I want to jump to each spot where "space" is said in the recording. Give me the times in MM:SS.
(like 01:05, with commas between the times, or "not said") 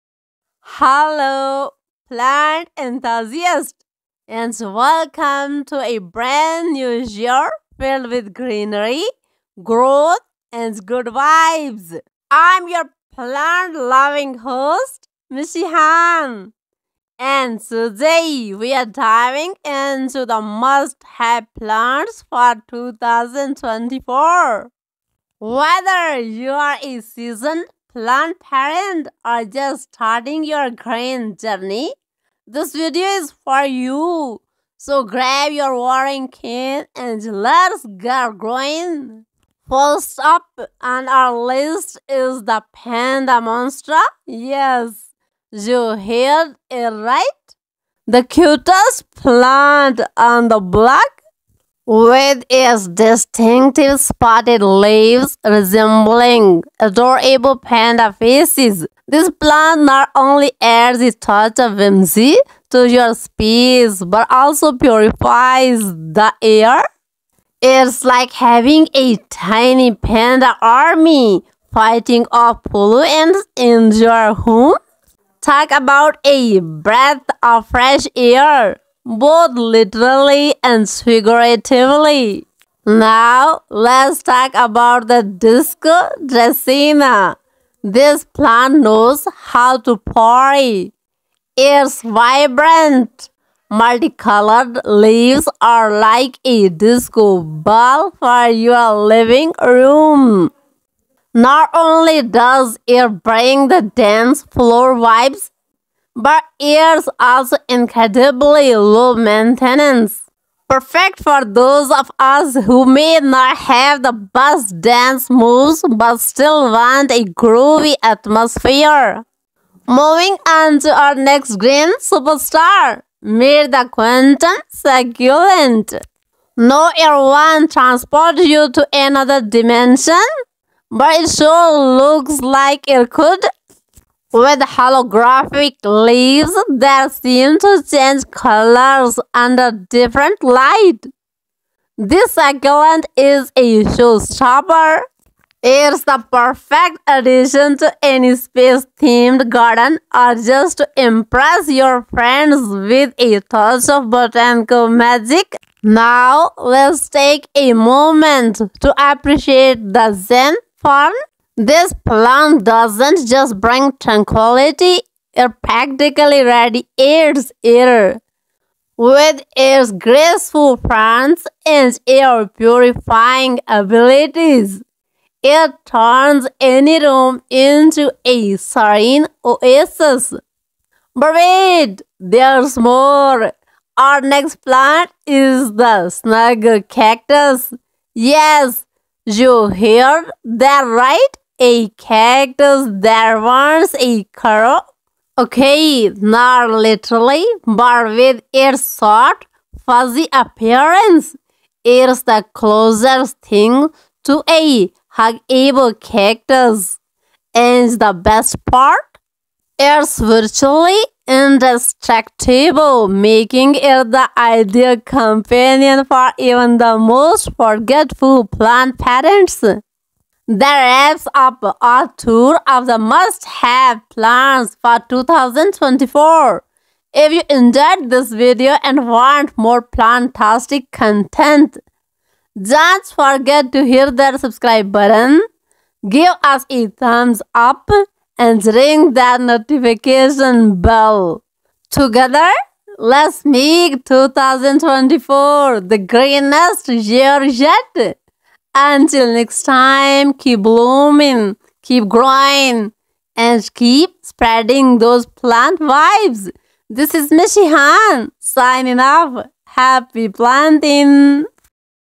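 01:03, 02:28.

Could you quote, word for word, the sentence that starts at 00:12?
I'm your plant loving host, Mishi Khan.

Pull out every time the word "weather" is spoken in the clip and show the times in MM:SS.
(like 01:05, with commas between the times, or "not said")
not said.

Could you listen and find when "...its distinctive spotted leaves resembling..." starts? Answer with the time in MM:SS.
00:52.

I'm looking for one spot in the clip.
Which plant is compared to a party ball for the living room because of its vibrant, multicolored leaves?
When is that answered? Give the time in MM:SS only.
01:25.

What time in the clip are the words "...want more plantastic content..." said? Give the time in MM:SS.
03:49.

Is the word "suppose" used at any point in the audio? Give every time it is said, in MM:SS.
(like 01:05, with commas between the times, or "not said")
not said.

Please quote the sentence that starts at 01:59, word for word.
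Moving on to our next green superstar, Mirda Quentin Succulent.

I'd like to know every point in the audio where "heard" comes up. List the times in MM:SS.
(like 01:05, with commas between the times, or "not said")
00:45, 03:09.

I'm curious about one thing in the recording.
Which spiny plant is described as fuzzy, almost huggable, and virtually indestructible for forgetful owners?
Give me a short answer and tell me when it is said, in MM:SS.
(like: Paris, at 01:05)
Snug cactus, at 03:06.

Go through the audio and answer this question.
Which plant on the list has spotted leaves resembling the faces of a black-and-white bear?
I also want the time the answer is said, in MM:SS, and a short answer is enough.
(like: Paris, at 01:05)
Panda monster, at 00:42.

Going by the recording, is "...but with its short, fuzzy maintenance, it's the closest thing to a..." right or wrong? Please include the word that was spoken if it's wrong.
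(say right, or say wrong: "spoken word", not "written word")
wrong: "appearance", not "maintenance".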